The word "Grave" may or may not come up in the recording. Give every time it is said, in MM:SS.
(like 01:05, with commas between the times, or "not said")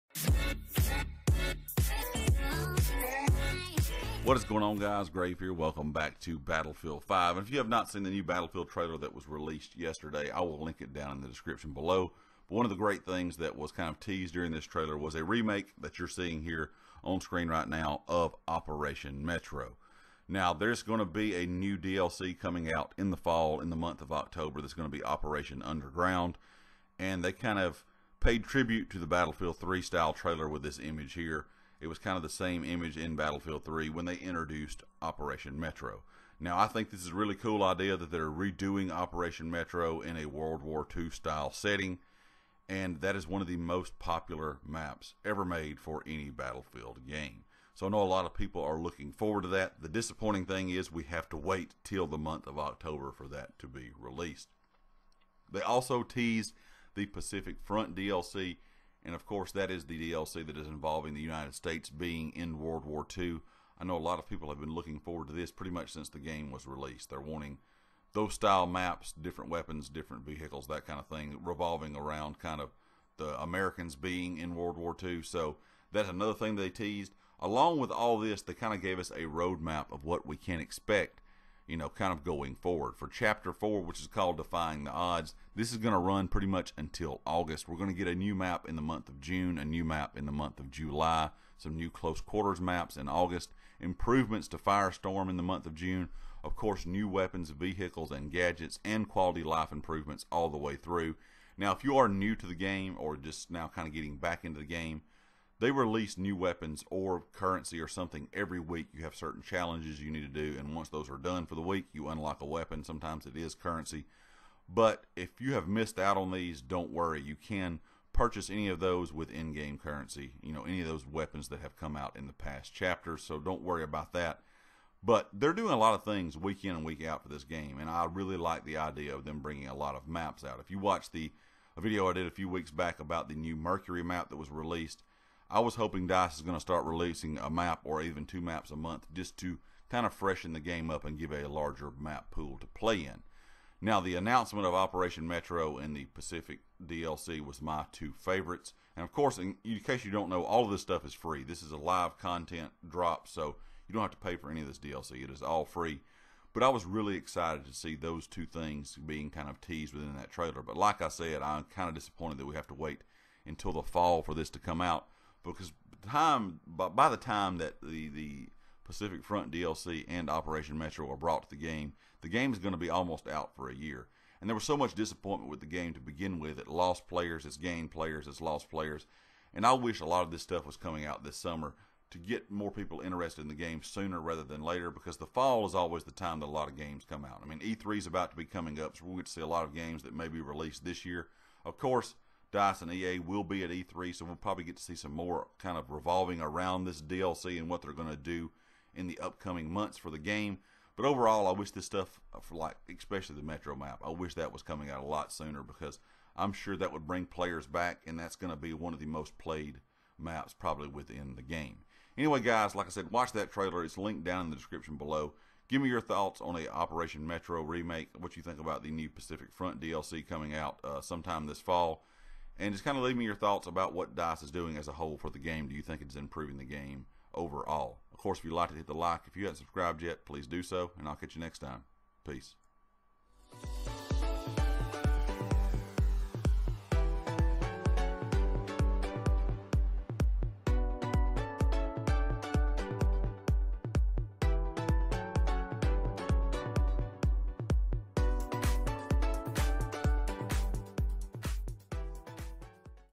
00:05.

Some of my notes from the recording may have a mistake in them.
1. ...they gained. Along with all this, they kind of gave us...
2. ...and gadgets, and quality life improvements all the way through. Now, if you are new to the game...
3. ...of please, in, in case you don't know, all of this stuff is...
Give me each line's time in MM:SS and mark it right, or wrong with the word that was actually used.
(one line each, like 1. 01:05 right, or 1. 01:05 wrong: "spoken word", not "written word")
1. 01:16 wrong: "teased", not "gained"
2. 01:38 right
3. 02:29 wrong: "course", not "please".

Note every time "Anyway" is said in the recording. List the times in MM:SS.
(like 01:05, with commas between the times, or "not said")
03:32.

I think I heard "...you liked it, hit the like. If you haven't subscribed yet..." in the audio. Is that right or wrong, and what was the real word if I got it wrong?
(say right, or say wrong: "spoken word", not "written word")
right.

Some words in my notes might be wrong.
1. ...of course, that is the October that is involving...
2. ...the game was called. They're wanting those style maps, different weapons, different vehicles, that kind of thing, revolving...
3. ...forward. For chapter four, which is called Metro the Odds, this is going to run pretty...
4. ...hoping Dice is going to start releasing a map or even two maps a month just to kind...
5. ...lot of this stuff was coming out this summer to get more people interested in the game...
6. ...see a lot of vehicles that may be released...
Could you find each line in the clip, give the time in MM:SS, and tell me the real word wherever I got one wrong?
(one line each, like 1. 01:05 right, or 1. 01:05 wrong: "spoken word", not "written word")
1. 00:59 wrong: "DLC", not "October"
2. 01:06 wrong: "released", not "called"
3. 01:22 wrong: "Defying", not "Metro"
4. 02:15 right
5. 03:00 right
6. 03:09 wrong: "games", not "vehicles".